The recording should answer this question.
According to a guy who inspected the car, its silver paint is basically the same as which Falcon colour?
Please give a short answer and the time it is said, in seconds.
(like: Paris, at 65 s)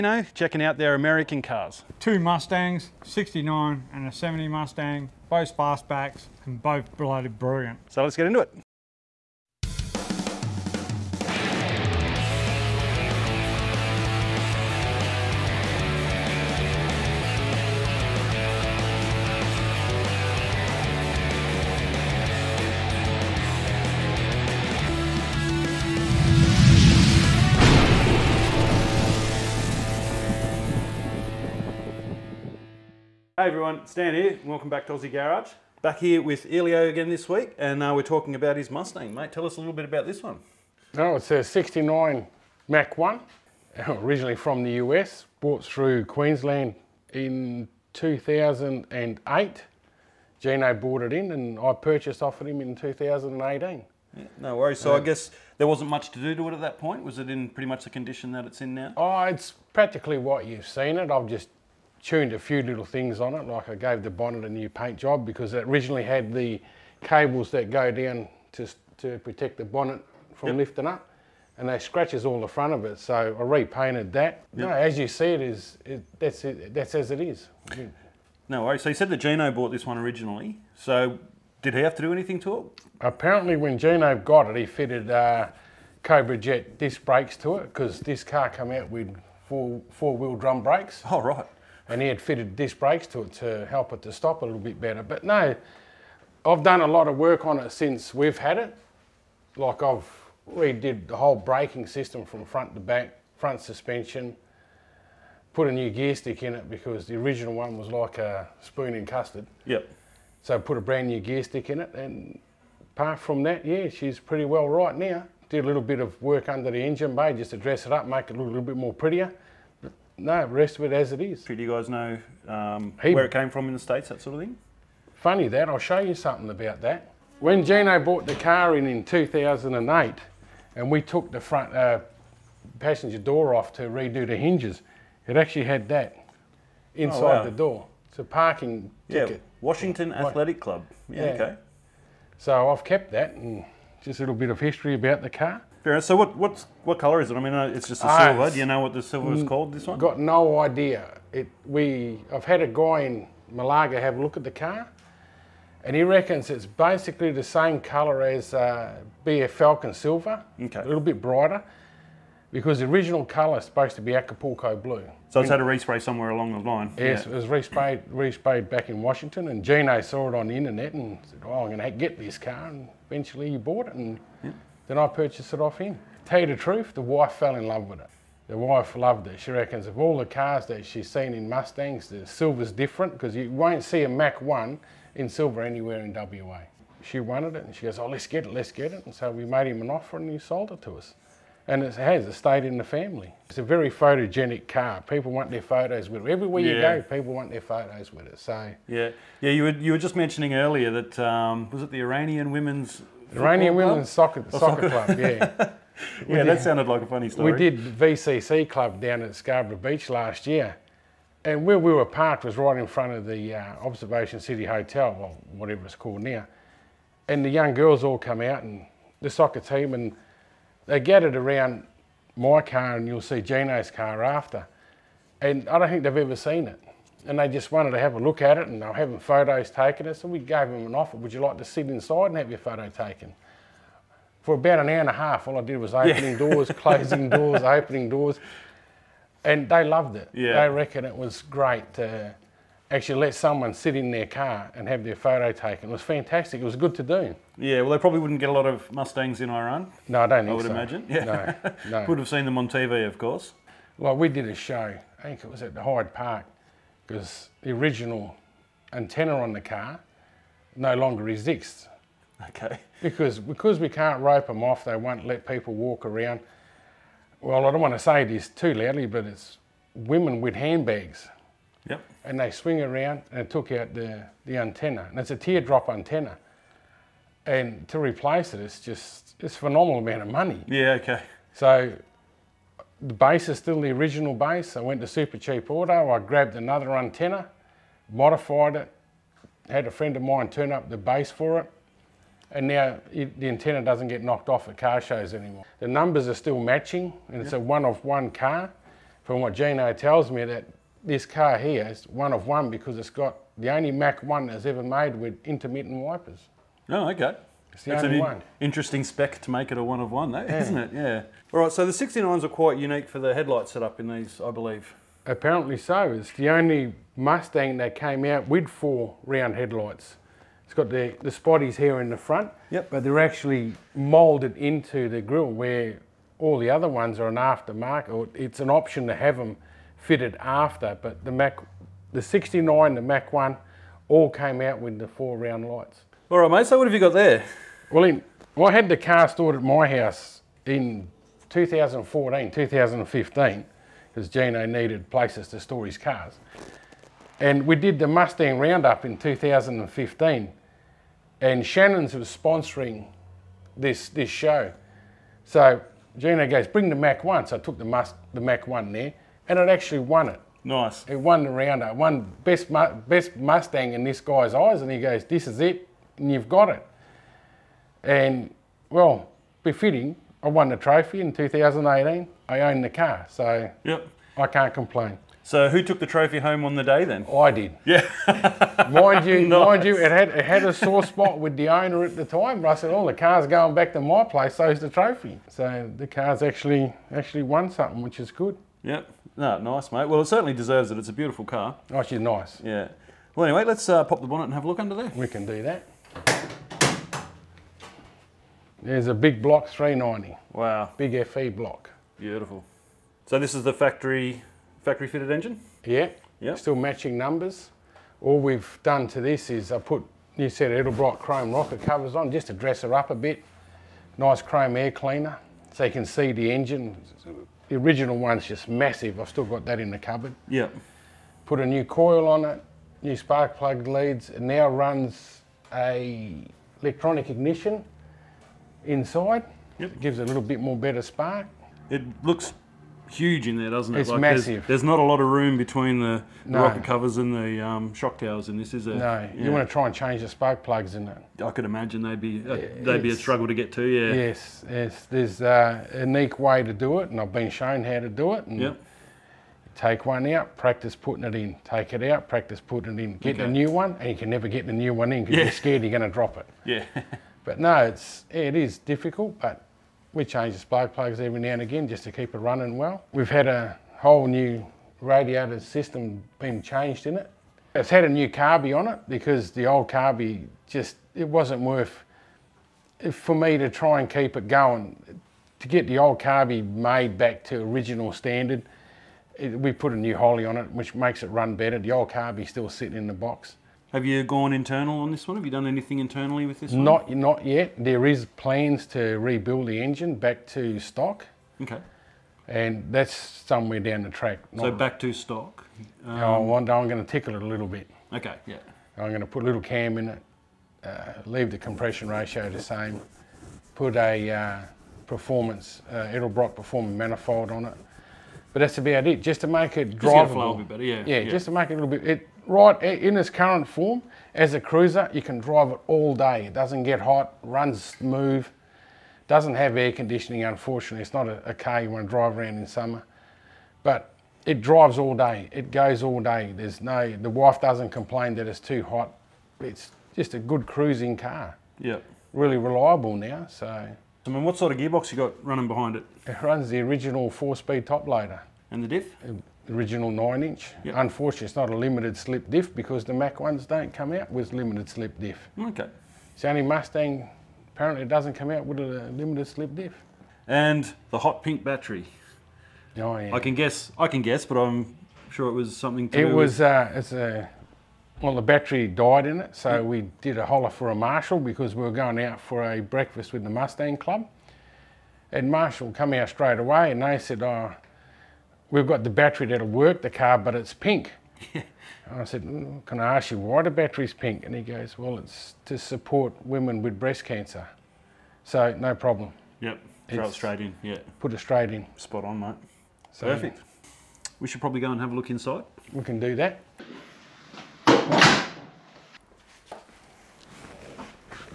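BF Falcon Silver, at 159 s.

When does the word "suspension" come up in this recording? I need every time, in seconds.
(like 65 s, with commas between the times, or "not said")
103 s.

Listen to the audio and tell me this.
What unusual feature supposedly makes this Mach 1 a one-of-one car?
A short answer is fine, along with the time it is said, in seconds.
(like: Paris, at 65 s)
Intermittent wipers, at 305 s.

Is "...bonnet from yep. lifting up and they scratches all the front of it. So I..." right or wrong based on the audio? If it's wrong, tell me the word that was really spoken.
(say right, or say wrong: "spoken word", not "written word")
right.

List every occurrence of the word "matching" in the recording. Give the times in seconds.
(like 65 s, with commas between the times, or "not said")
296 s, 406 s.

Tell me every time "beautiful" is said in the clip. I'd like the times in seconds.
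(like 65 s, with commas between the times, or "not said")
391 s, 402 s.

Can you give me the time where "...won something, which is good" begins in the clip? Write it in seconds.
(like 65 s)
387 s.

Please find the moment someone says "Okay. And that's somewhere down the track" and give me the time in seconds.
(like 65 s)
491 s.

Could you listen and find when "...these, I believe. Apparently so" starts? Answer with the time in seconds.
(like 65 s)
314 s.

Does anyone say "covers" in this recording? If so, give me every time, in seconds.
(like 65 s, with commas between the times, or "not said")
411 s, 436 s.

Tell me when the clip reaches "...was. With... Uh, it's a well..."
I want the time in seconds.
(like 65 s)
556 s.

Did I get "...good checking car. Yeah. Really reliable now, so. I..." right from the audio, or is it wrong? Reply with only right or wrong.
wrong.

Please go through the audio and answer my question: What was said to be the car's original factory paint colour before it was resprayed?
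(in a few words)
Acapulco blue.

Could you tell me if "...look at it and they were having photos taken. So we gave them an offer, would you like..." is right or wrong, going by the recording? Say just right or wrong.
right.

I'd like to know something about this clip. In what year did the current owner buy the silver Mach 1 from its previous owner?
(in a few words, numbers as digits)
2018.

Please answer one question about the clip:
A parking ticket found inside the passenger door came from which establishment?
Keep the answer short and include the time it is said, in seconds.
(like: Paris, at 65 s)
Washington Athletic Club, at 139 s.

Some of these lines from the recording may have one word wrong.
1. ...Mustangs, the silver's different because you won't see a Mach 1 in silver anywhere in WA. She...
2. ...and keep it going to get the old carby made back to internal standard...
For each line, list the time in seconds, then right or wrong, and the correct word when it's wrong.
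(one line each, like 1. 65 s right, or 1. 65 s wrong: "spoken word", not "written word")
1. 181 s right
2. 474 s wrong: "original", not "internal".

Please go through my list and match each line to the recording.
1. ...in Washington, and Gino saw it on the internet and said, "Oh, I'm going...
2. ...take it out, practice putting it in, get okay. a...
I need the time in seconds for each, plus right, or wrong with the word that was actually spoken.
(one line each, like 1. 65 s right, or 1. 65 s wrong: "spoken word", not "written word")
1. 168 s right
2. 451 s right.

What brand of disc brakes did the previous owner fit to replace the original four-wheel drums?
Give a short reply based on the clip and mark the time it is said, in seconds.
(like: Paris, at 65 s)
Cobra Jet, at 86 s.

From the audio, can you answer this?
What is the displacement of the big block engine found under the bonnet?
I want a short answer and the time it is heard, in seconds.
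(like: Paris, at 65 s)
390, at 399 s.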